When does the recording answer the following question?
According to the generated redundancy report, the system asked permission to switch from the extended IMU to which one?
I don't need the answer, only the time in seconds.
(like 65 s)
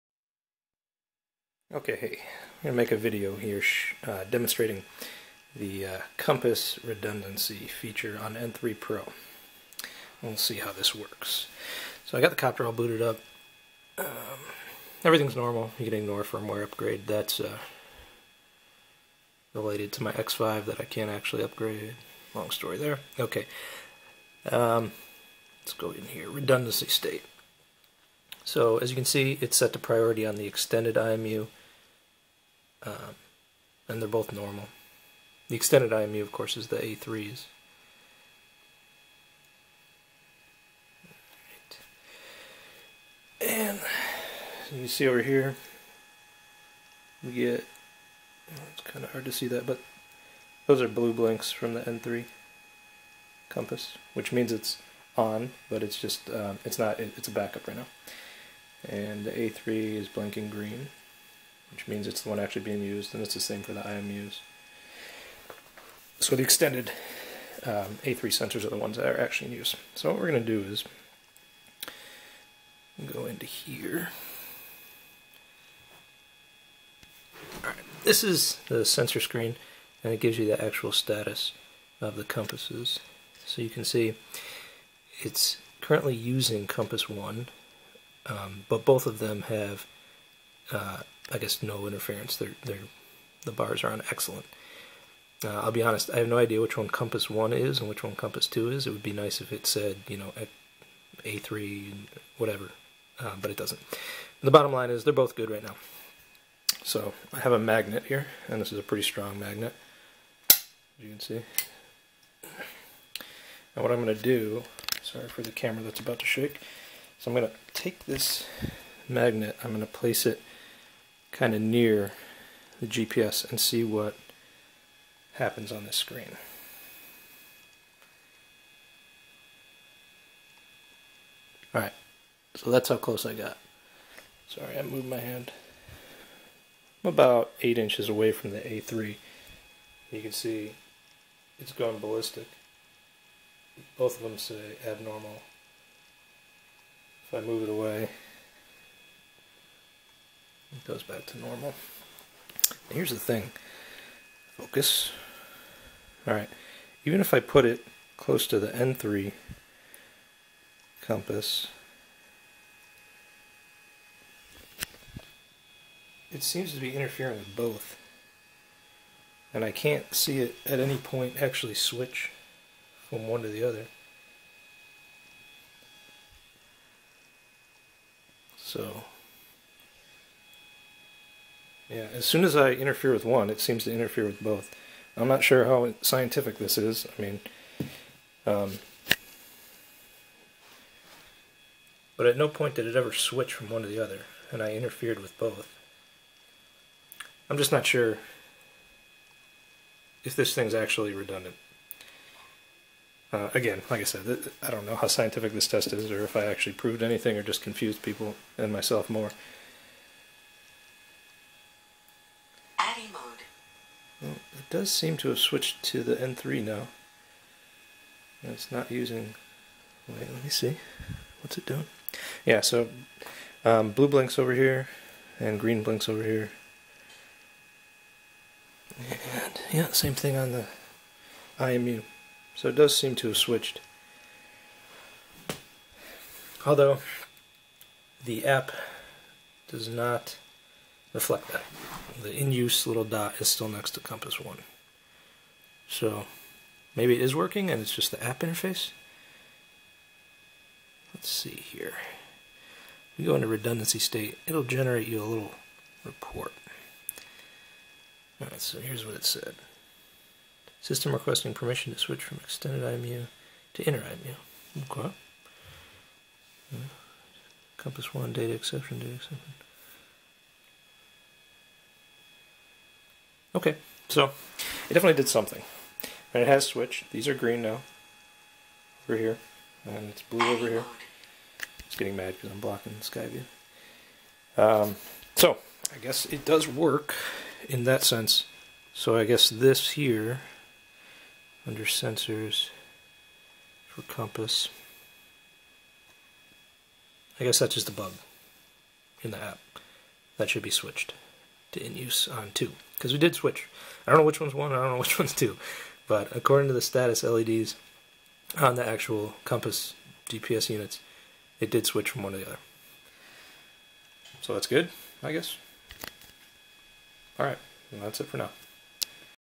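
263 s.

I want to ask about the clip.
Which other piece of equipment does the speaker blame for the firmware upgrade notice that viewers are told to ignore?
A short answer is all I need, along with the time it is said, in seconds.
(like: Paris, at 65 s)
X5, at 20 s.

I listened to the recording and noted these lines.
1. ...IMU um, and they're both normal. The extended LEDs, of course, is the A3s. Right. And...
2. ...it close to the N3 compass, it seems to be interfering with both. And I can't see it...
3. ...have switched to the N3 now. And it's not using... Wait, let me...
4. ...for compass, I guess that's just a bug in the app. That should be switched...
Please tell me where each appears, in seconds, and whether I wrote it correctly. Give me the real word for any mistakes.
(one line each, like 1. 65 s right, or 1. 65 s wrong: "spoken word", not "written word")
1. 30 s wrong: "IMU", not "LEDs"
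2. 157 s right
3. 215 s right
4. 293 s right.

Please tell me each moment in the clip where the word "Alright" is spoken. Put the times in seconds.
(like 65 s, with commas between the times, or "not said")
77 s, 131 s, 156 s, 258 s.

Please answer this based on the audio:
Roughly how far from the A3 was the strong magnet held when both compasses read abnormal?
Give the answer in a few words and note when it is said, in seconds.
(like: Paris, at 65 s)
8 inches, at 137 s.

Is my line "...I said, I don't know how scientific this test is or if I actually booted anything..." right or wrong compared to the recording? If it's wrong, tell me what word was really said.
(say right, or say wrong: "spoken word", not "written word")
wrong: "proved", not "booted".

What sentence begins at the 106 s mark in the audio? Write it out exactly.
So I have a magnet here, and this is a pretty strong magnet, as you can see.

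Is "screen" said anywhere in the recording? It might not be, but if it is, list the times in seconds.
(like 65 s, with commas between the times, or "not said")
79 s, 125 s.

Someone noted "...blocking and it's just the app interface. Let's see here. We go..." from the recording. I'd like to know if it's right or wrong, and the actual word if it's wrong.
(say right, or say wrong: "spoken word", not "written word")
wrong: "working", not "blocking".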